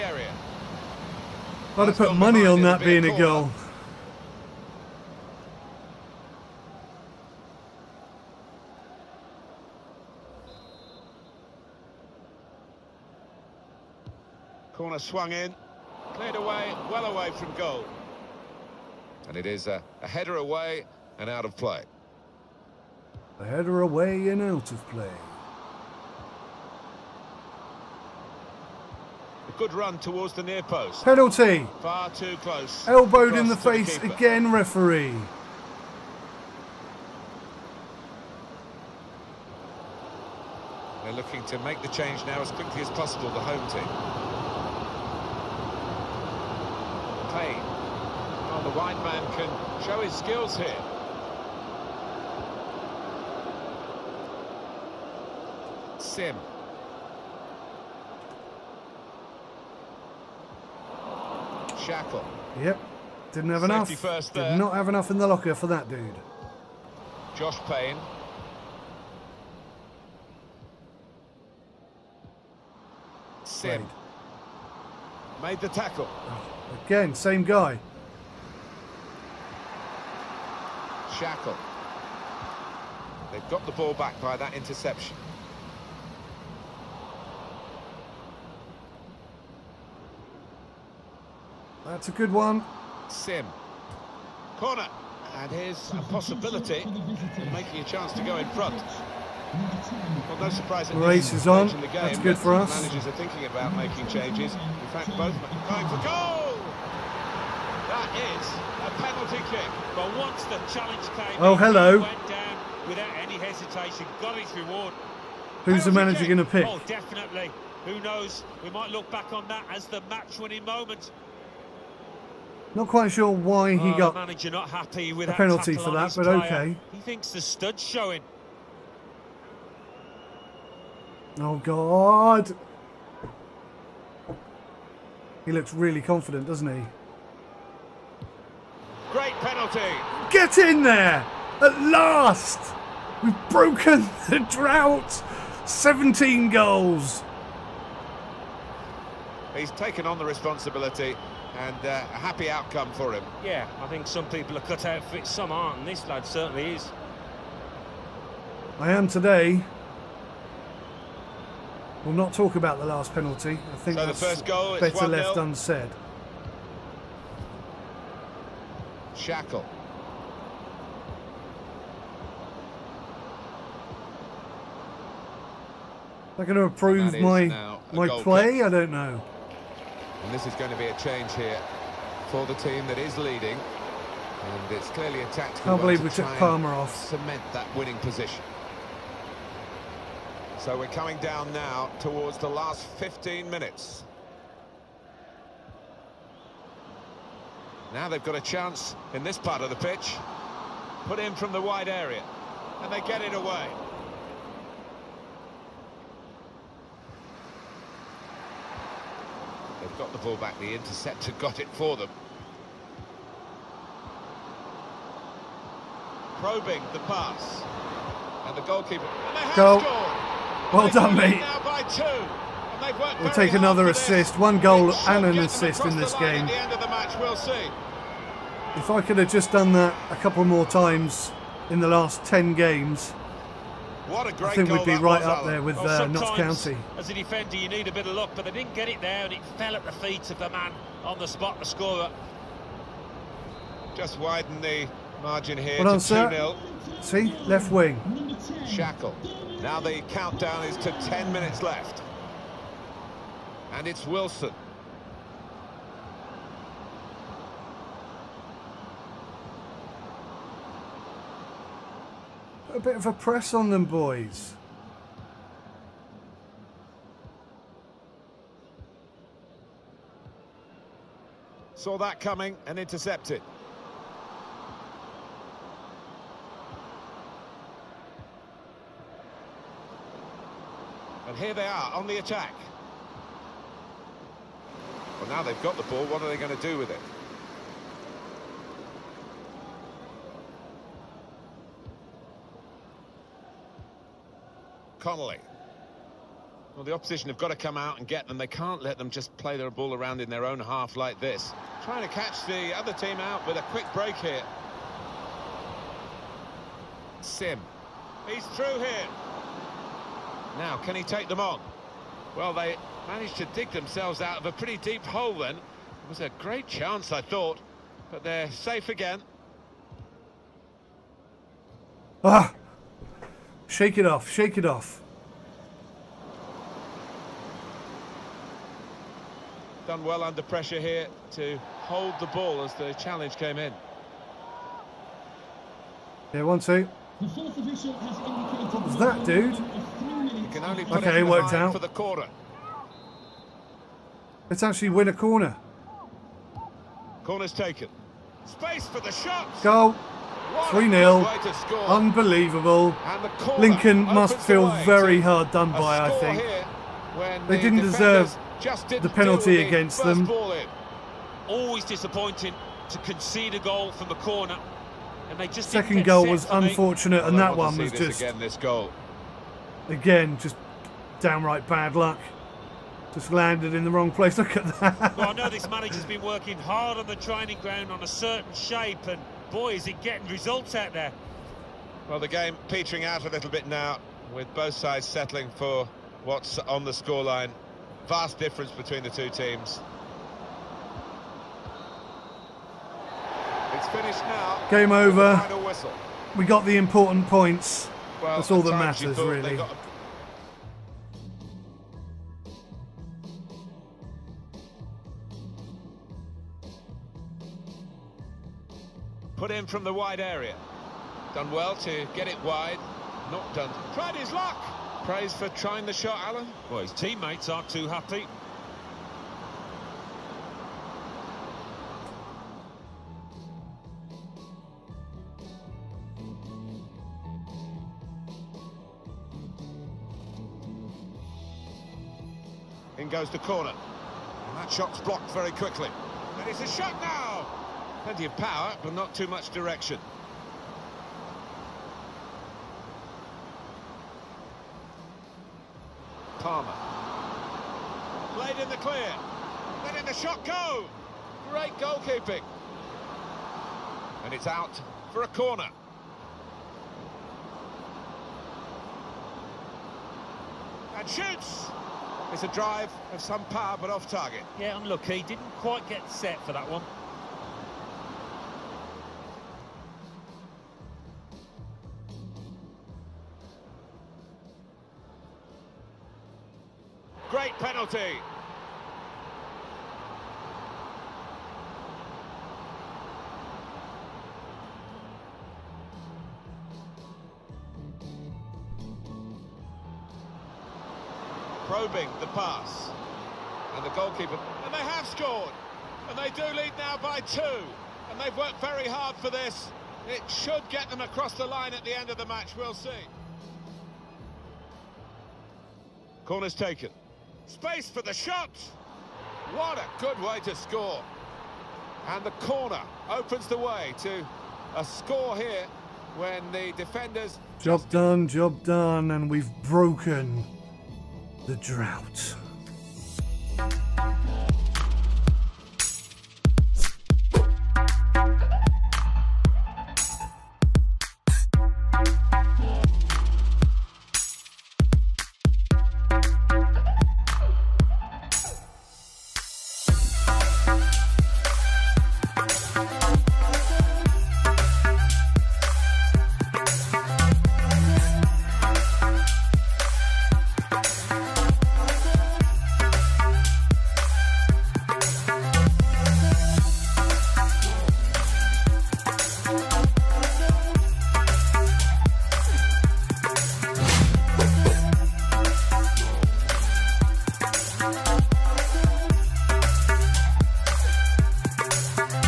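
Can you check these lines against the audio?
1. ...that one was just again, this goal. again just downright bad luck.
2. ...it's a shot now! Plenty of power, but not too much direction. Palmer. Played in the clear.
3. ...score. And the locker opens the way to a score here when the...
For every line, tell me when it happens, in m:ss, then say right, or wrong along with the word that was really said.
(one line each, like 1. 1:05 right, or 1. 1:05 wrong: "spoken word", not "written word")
1. 6:07 right
2. 7:16 right
3. 8:30 wrong: "corner", not "locker".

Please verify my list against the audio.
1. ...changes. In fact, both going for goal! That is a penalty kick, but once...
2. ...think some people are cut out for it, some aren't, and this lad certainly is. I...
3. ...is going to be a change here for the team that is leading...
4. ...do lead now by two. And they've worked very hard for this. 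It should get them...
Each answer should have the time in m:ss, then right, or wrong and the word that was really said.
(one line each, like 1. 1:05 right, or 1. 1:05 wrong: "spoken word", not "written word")
1. 1:44 right
2. 2:33 right
3. 3:00 right
4. 8:16 right.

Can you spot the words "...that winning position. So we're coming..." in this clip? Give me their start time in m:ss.
3:07.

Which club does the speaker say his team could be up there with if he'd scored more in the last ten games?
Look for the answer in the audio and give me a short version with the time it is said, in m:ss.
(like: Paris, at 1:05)
Notts County, at 3:56.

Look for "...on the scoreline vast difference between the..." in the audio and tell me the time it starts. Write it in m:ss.
6:26.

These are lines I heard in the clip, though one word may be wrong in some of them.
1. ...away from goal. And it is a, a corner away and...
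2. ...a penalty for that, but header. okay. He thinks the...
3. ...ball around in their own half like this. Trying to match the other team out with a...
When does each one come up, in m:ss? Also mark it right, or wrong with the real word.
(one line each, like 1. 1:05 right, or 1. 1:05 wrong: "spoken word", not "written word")
1. 0:17 wrong: "header", not "corner"
2. 2:05 wrong: "player", not "header"
3. 4:59 wrong: "catch", not "match".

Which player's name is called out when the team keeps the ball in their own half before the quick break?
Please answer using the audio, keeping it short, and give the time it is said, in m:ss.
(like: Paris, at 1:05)
Connolly, at 4:55.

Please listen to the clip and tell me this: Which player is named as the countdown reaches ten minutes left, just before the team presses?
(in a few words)
Wilson.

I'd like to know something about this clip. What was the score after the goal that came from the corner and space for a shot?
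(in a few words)
3-0.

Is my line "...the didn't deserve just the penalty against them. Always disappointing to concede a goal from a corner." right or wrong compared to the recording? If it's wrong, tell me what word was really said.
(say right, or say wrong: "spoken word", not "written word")
right.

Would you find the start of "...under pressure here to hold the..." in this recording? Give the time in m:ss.
5:30.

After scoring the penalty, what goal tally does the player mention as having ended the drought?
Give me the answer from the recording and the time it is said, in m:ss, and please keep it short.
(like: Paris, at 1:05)
17 goals, at 2:25.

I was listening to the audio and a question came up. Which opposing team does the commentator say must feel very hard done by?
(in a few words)
Lincoln.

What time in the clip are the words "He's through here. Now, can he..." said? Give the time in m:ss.
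5:08.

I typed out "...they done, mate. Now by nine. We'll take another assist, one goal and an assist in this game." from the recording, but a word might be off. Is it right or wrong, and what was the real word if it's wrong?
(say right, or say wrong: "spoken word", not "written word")
wrong: "two", not "nine".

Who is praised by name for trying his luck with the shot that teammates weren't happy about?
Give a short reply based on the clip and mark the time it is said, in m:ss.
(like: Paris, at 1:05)
Alan, at 6:56.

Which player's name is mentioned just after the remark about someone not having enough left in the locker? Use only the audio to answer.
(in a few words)
Josh Payne.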